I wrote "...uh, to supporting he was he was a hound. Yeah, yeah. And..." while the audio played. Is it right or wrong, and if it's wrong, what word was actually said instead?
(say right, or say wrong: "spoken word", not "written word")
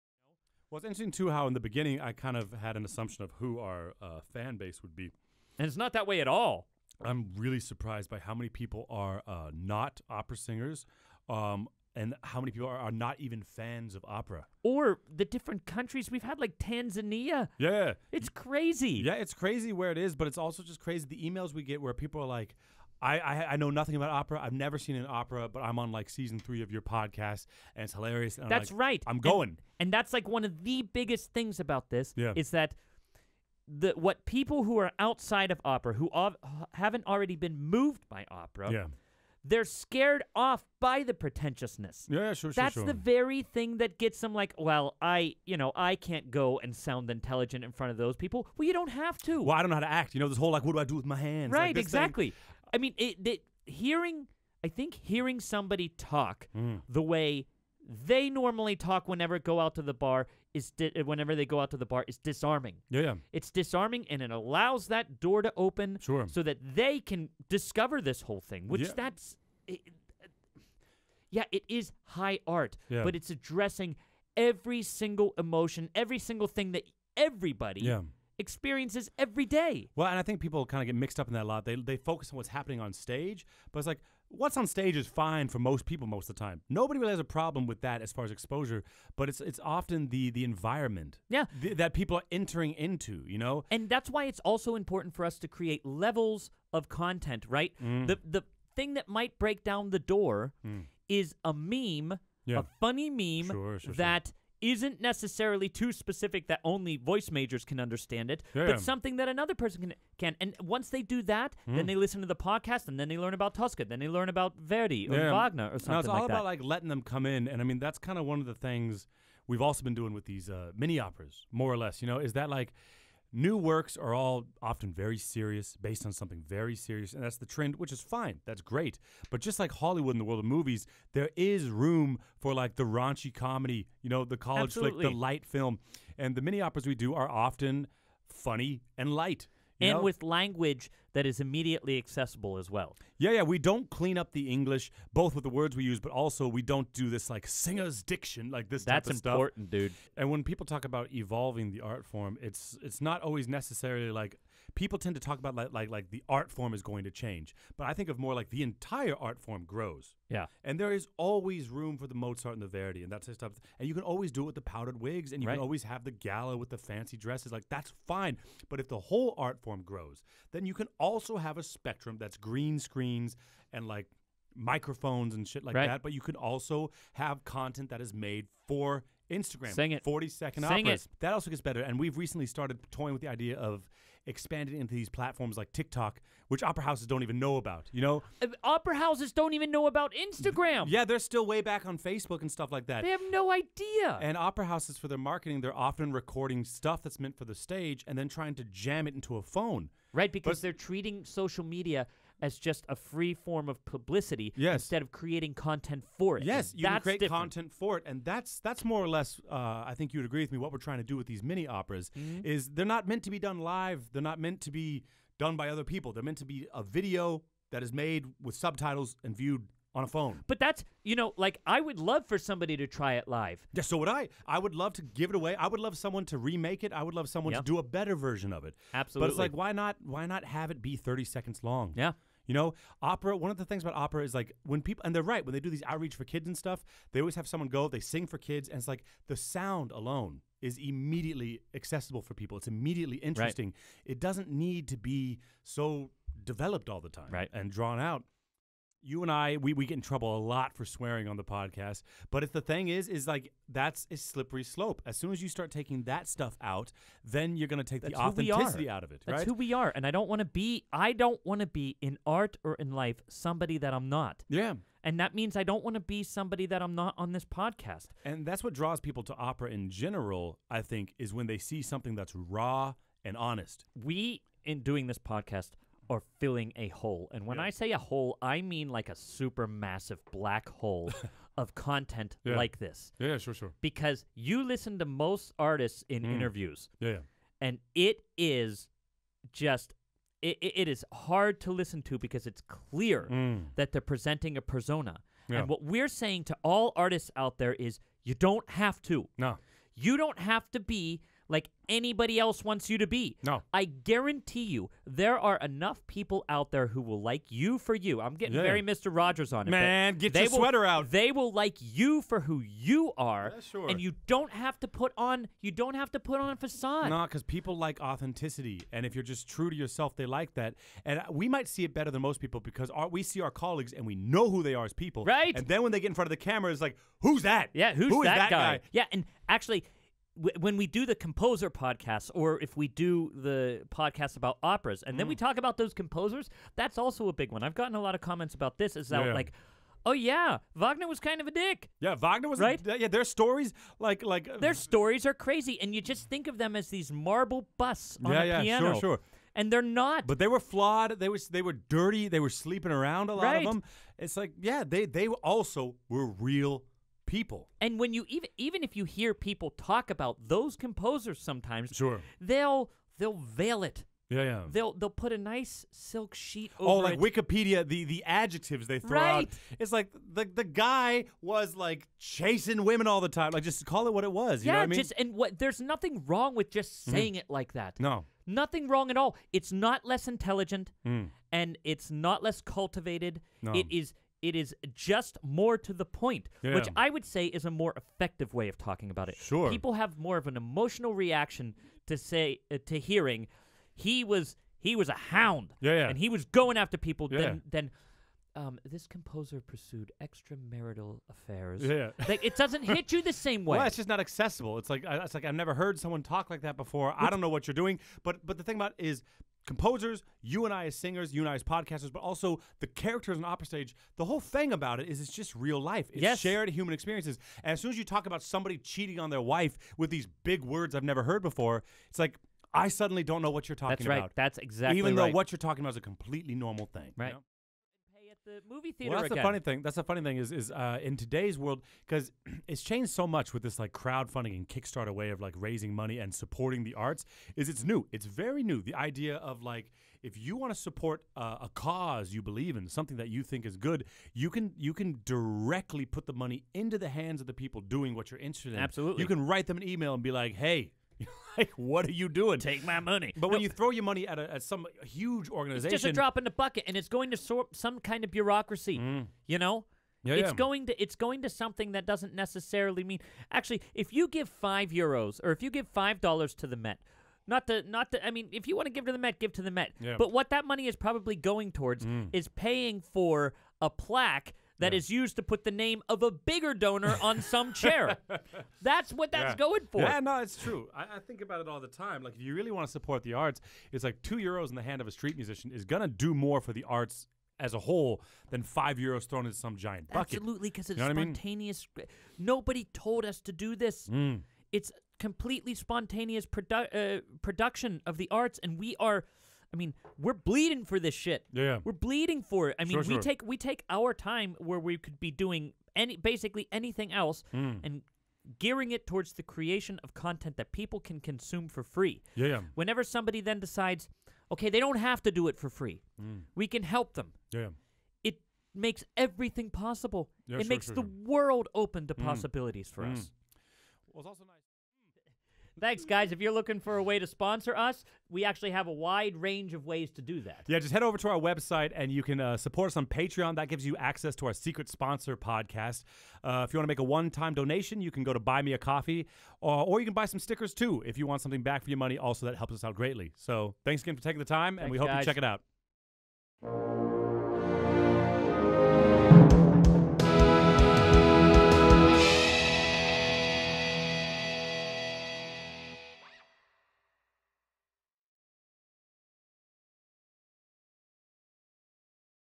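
wrong: "hearing", not "supporting".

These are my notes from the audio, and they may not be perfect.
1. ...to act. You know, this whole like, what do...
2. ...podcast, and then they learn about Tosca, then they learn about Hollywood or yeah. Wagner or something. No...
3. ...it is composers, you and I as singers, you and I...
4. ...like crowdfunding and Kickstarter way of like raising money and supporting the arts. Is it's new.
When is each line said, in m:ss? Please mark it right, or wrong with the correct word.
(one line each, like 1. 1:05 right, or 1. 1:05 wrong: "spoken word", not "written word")
1. 0:49 right
2. 1:52 wrong: "Verdi", not "Hollywood"
3. 6:48 right
4. 7:13 right.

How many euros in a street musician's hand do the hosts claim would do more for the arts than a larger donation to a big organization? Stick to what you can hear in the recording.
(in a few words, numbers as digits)
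2.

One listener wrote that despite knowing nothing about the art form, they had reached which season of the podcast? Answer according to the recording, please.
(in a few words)
season three.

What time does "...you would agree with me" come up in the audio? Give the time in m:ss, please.
3:30.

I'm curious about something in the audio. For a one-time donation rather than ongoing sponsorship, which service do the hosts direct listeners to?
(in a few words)
Buy Me a Coffee.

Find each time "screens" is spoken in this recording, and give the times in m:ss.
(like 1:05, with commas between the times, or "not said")
2:52.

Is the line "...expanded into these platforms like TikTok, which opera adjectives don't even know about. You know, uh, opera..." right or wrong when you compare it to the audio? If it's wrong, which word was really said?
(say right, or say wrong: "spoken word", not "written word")
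wrong: "houses", not "adjectives".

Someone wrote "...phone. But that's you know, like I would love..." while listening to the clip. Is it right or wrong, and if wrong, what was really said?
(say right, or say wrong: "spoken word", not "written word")
right.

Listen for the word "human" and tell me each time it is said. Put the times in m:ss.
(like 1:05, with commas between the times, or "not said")
6:56.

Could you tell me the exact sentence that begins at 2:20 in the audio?
with language that is immediately accessible as well.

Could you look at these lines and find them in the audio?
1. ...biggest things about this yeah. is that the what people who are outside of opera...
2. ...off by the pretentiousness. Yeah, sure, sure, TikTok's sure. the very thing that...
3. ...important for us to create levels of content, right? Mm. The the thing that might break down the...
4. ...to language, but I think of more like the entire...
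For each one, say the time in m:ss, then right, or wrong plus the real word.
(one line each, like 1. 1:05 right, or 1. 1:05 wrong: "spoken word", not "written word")
1. 0:30 right
2. 0:40 wrong: "That", not "TikTok"
3. 1:34 right
4. 2:37 wrong: "change", not "language".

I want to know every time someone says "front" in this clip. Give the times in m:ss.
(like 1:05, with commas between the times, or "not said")
0:47, 5:26.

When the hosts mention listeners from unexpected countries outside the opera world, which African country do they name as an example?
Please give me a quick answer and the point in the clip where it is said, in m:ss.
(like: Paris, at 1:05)
Tanzania, at 0:16.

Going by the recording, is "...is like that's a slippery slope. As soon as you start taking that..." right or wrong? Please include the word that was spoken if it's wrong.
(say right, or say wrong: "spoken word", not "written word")
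right.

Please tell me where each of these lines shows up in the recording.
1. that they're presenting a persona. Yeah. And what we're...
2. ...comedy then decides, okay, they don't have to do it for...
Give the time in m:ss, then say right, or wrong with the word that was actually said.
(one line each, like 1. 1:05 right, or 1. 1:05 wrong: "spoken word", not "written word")
1. 4:53 right
2. 8:33 wrong: "somebody", not "comedy".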